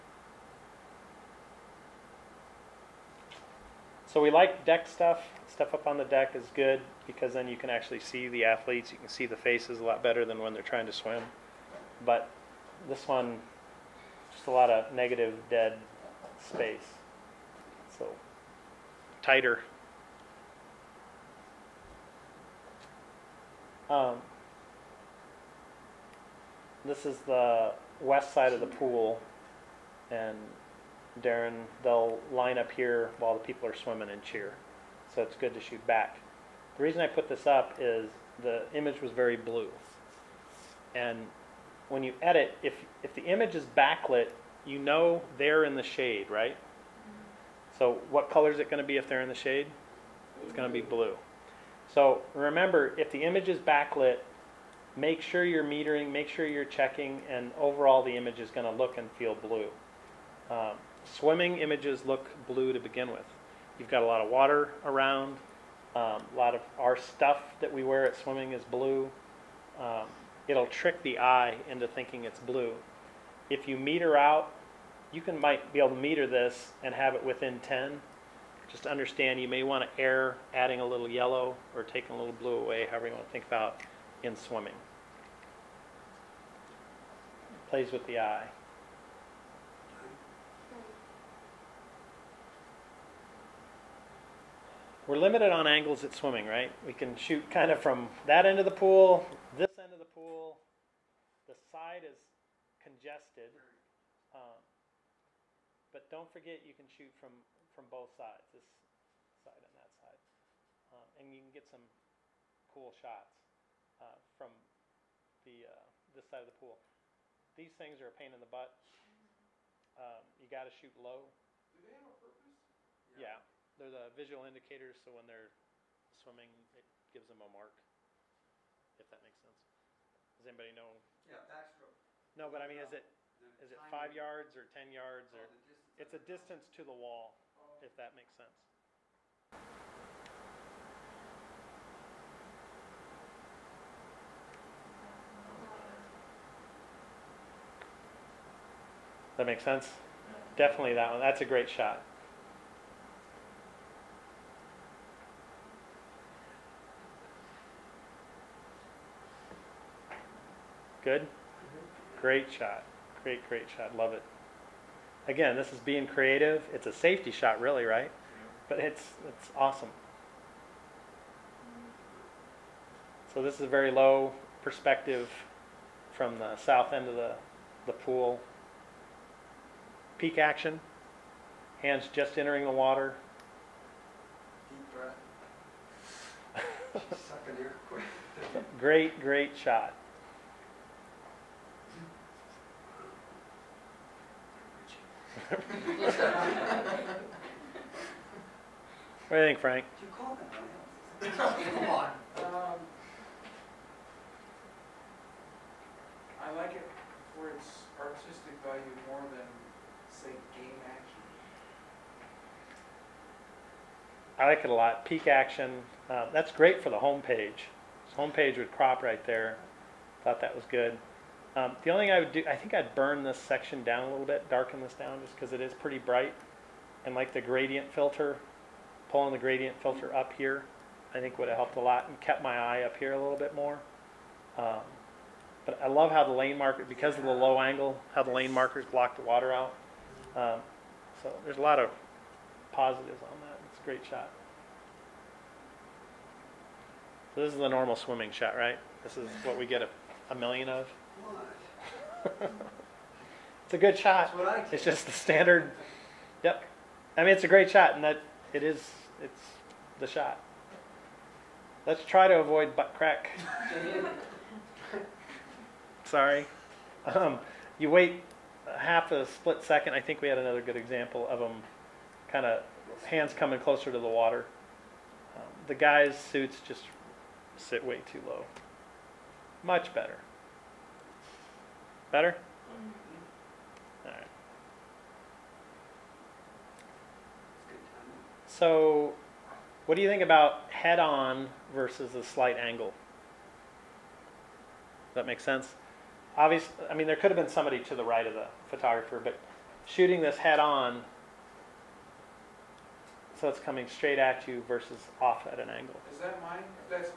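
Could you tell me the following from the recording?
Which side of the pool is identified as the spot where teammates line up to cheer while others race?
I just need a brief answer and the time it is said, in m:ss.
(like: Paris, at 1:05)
west side, at 0:28.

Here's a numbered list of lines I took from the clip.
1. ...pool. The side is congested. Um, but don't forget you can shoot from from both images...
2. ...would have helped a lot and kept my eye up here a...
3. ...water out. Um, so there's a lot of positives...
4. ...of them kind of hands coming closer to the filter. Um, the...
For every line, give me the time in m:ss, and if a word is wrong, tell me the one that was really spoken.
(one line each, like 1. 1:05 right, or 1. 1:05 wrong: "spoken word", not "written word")
1. 1:40 wrong: "sides", not "images"
2. 3:51 right
3. 3:59 right
4. 4:31 wrong: "water", not "filter".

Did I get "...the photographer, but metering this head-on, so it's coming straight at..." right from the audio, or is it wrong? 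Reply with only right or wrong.
wrong.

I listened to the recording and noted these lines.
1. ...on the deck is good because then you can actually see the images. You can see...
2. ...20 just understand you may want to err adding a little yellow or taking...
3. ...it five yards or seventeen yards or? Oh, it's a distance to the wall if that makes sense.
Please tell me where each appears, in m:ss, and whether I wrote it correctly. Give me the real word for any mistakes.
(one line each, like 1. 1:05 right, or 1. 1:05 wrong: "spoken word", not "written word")
1. 0:05 wrong: "athletes", not "images"
2. 1:17 wrong: "10", not "20"
3. 2:13 wrong: "ten", not "seventeen".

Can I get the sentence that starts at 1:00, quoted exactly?
Um, swimming images look blue to begin with.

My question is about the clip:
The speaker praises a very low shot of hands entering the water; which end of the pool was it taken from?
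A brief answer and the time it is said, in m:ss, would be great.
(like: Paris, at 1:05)
south end, at 2:56.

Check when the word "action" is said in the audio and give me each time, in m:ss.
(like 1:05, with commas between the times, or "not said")
3:00, 3:30, 3:35.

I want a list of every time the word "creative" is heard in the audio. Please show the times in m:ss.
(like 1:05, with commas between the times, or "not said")
2:46.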